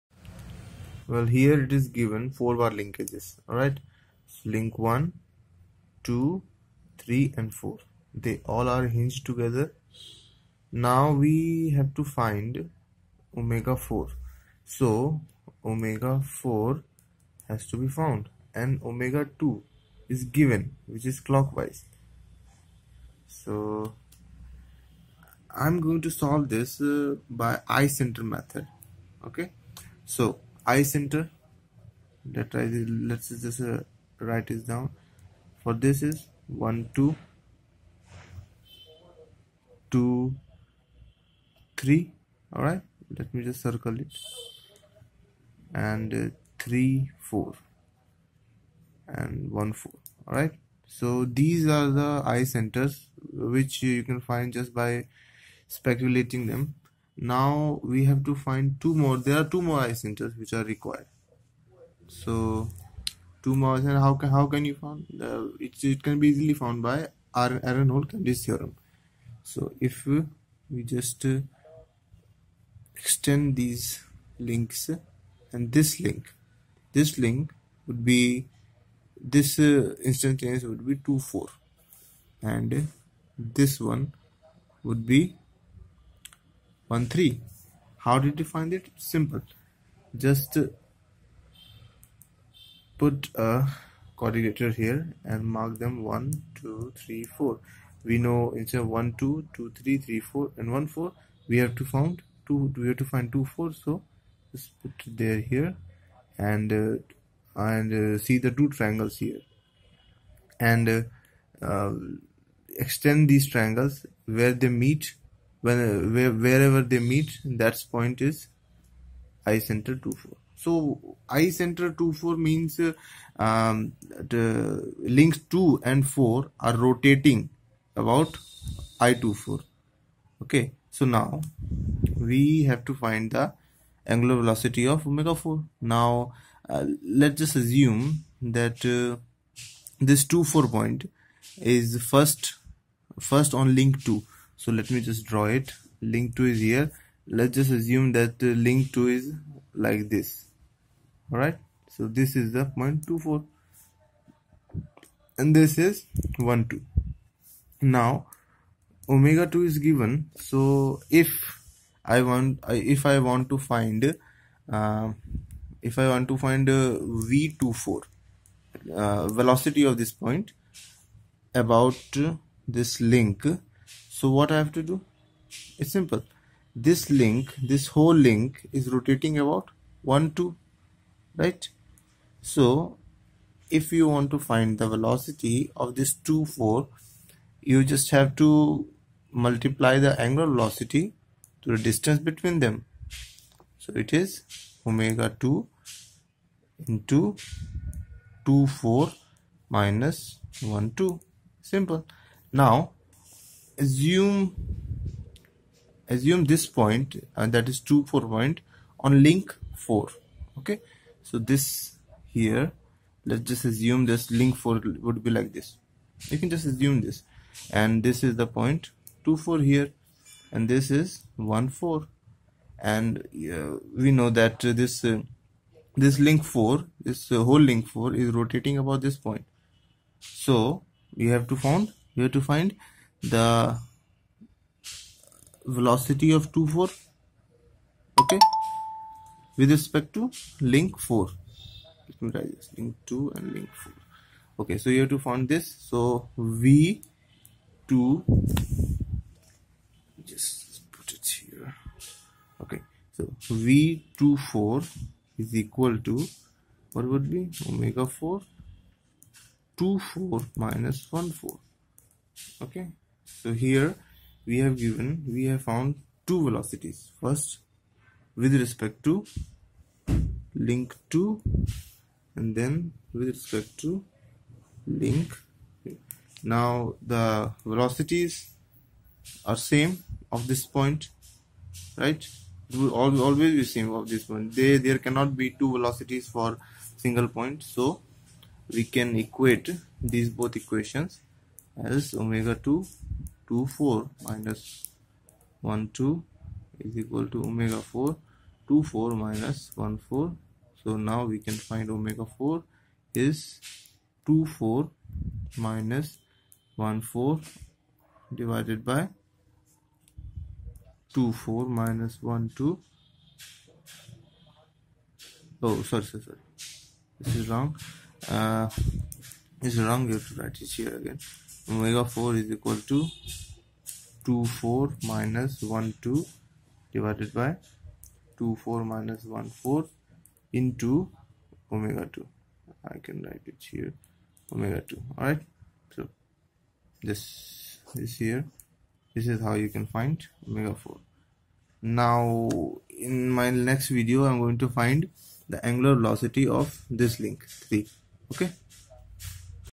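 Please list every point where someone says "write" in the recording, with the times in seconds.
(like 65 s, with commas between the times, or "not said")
34 s, 320 s, 333 s.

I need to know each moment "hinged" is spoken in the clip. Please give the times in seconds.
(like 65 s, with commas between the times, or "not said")
8 s.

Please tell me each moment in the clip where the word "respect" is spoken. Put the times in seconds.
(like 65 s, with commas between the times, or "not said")
239 s, 268 s, 273 s.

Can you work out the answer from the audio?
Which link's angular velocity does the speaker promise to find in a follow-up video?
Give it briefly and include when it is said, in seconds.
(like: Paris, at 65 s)
Link 3, at 347 s.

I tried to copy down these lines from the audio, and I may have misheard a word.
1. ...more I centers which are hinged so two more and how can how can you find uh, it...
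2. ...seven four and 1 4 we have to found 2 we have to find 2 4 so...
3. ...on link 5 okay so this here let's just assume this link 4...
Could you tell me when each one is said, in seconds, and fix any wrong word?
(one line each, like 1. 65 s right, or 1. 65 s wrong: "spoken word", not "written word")
1. 59 s wrong: "required", not "hinged"
2. 100 s wrong: "three", not "seven"
3. 208 s wrong: "4", not "5".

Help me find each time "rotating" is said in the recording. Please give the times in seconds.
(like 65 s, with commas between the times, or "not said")
126 s, 178 s, 228 s.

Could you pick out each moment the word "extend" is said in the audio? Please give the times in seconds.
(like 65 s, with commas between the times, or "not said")
72 s, 112 s.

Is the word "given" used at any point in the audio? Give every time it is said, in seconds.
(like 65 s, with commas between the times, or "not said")
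1 s, 20 s, 159 s, 264 s.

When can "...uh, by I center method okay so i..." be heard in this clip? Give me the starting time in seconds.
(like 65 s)
26 s.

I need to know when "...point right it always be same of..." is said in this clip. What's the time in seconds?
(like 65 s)
280 s.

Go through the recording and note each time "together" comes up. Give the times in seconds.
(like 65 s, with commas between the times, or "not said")
9 s.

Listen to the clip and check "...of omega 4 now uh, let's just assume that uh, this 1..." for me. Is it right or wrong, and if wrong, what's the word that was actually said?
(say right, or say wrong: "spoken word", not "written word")
wrong: "2", not "1".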